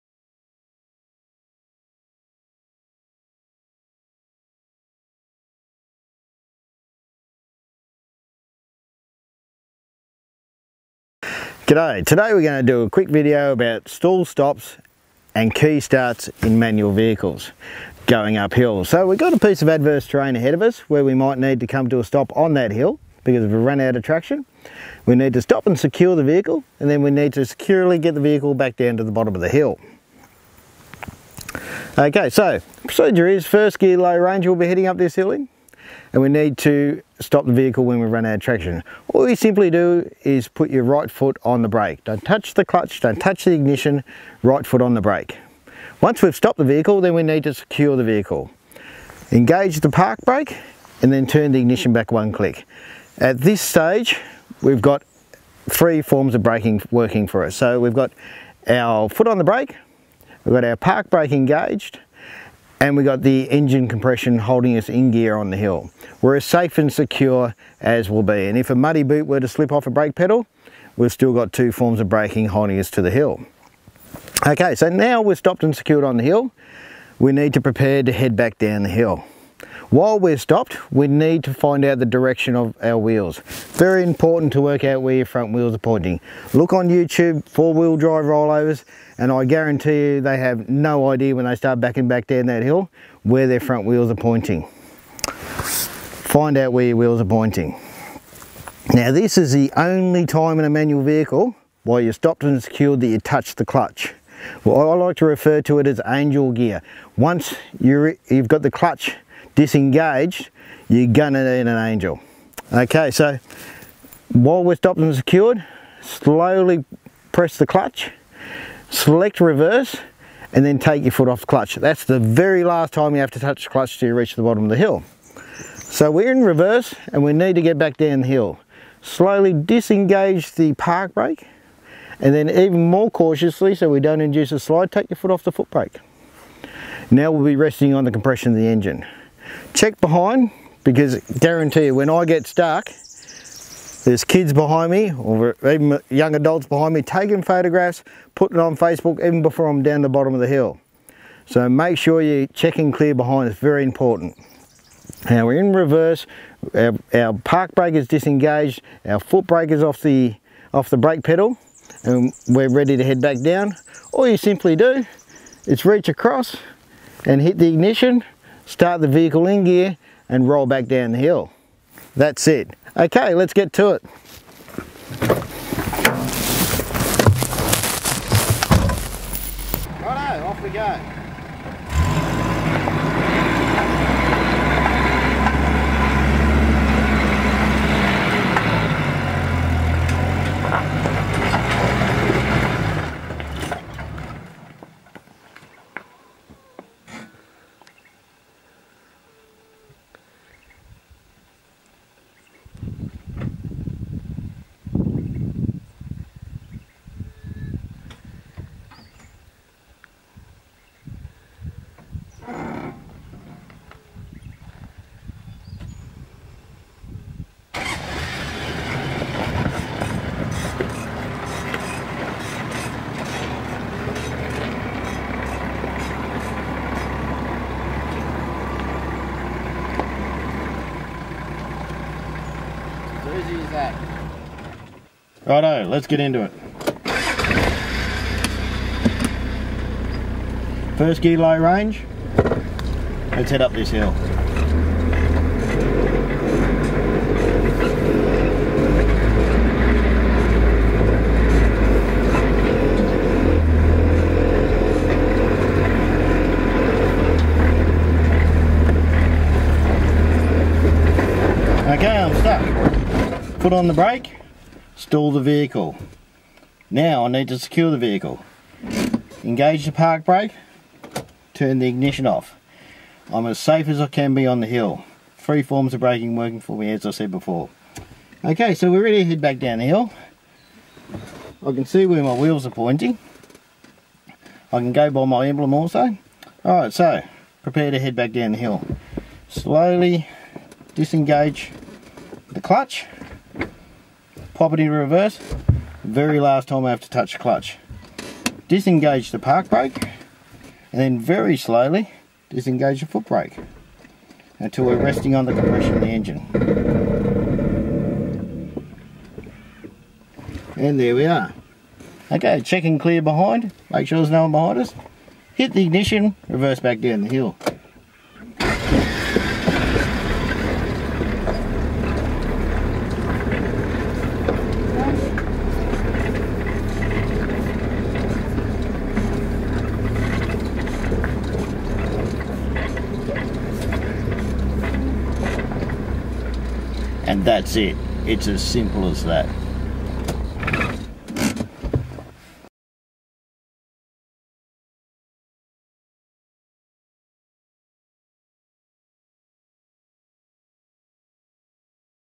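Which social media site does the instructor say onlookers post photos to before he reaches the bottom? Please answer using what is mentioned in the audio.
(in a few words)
Facebook.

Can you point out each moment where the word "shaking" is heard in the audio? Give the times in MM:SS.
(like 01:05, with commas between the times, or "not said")
not said.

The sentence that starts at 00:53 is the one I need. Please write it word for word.
At this stage, we've got three forms of braking working for us.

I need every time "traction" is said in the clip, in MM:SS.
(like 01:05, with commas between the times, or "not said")
00:24, 00:38.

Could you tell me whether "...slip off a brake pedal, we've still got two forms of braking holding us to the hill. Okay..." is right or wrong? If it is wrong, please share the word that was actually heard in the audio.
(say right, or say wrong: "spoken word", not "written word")
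right.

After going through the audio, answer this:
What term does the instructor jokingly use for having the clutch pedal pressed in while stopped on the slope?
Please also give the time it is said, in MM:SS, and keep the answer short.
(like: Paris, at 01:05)
Angel gear, at 01:46.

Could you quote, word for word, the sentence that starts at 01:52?
Okay, so while we're stopped and secured, slowly press the clutch, select reverse, and then take your foot off the clutch.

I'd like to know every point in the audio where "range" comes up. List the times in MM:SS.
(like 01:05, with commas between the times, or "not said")
00:34, 04:01.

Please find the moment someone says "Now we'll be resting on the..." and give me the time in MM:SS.
02:17.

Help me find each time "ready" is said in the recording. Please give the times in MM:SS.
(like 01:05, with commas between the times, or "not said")
02:42, 04:39.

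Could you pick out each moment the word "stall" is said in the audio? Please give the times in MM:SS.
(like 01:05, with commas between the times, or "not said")
00:13, 04:24.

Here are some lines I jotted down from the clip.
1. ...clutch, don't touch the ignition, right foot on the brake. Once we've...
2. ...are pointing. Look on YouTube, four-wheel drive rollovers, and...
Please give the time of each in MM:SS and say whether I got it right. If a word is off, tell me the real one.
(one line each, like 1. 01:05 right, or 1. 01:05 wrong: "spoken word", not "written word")
1. 00:42 right
2. 01:25 right.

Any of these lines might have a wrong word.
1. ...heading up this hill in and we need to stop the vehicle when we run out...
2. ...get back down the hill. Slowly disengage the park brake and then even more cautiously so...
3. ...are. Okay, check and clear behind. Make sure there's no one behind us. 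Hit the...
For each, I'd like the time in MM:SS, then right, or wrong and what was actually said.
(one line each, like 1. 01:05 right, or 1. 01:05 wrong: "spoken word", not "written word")
1. 00:34 right
2. 02:07 right
3. 05:11 right.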